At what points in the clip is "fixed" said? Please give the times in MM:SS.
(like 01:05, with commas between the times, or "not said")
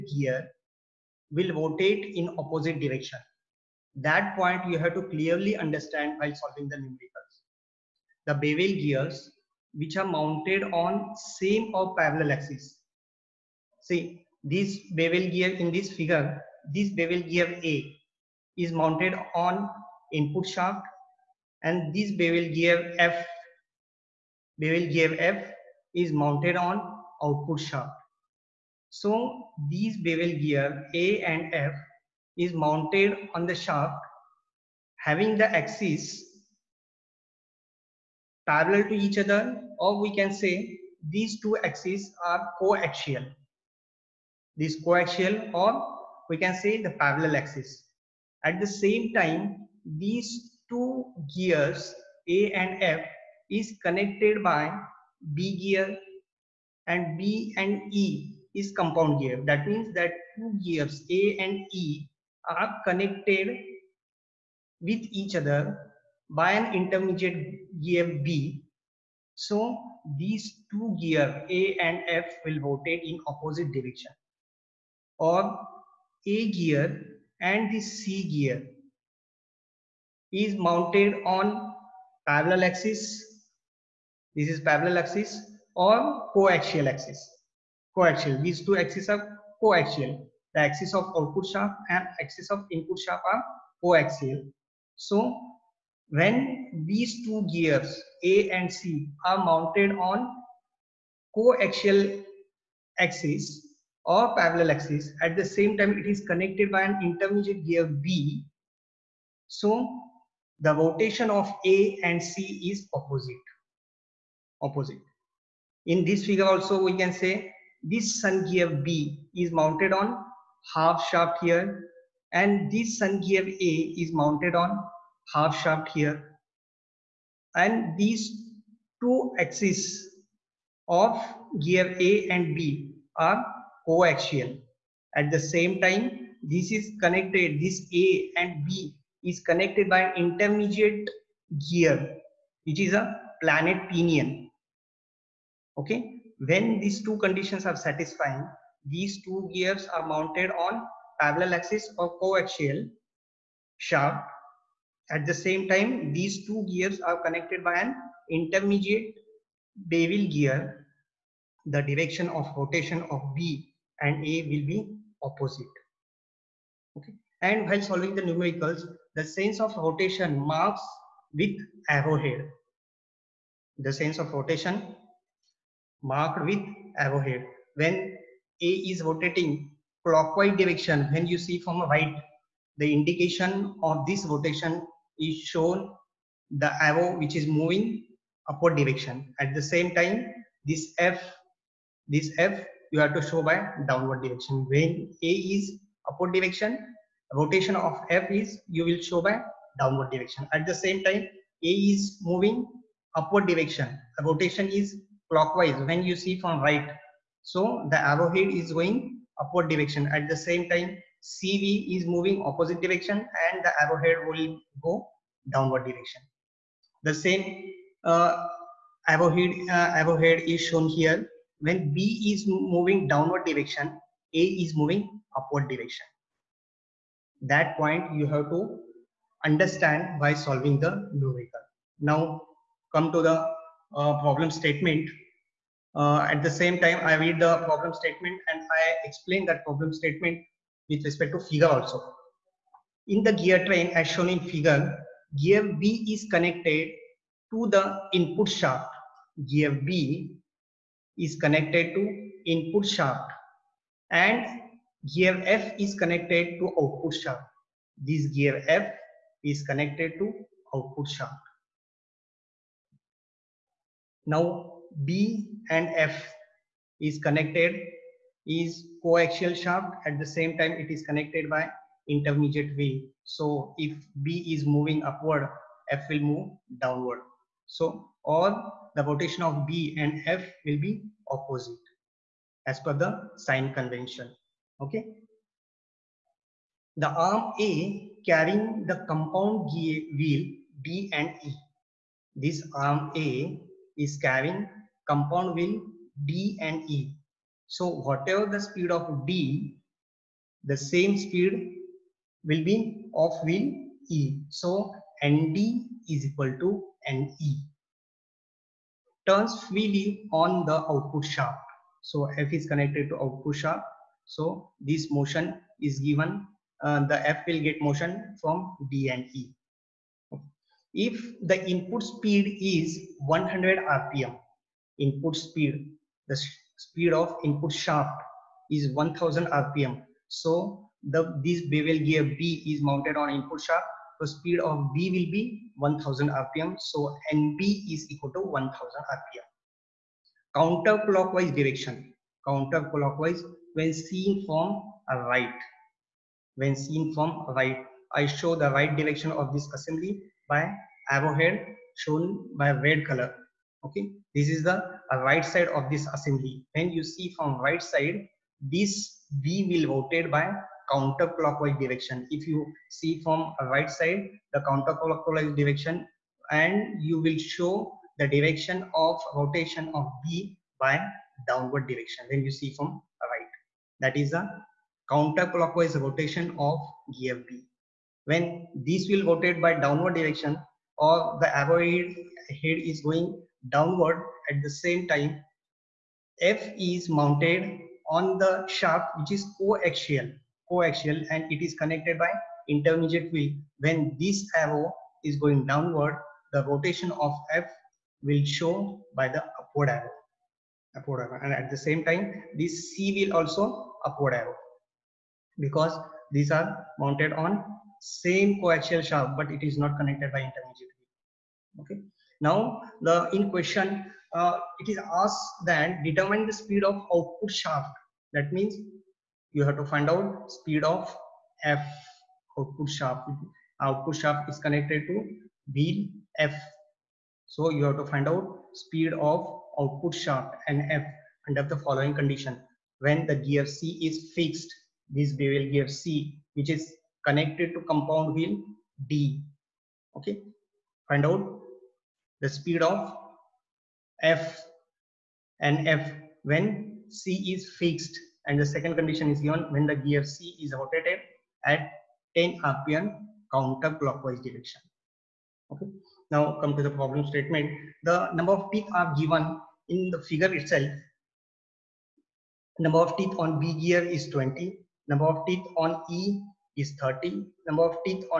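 07:14, 07:27.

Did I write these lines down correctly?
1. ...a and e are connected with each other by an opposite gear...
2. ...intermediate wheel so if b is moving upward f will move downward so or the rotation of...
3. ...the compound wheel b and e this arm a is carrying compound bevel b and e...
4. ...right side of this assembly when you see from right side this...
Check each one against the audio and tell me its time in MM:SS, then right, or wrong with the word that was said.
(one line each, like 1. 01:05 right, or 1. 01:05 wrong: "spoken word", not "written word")
1. 01:01 wrong: "intermediate", not "opposite"
2. 04:32 right
3. 04:48 wrong: "wheel", not "bevel"
4. 05:55 right.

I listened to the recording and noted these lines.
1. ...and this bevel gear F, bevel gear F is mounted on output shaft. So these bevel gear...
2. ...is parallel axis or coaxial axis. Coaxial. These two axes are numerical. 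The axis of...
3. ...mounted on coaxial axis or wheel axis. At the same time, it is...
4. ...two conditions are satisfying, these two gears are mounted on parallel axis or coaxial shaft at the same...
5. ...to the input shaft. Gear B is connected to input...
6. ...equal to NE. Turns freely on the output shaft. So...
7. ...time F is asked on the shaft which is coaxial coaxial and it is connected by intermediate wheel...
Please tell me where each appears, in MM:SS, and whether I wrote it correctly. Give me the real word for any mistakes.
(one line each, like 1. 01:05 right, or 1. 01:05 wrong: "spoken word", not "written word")
1. 00:21 right
2. 01:24 wrong: "coaxial", not "numerical"
3. 01:39 wrong: "parallel", not "wheel"
4. 02:27 right
5. 04:07 right
6. 05:06 right
7. 06:25 wrong: "mounted", not "asked".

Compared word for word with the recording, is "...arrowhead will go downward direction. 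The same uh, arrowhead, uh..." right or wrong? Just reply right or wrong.
right.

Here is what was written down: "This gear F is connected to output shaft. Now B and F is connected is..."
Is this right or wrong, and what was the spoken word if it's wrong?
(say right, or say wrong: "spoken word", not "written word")
right.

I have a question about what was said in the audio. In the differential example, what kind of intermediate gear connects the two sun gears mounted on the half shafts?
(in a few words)
planet pinion.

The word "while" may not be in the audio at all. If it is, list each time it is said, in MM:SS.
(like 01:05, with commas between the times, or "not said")
00:06, 02:47.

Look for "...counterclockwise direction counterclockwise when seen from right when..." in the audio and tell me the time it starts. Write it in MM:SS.
05:40.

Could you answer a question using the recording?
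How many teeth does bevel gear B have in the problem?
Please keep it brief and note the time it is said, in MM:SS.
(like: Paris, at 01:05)
20, at 07:44.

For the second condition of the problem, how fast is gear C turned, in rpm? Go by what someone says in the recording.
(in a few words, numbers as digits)
10 rpm.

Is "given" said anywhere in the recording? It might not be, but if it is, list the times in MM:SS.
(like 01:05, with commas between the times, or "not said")
05:15, 07:29, 07:39.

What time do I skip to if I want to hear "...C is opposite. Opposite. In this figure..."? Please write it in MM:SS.
01:52.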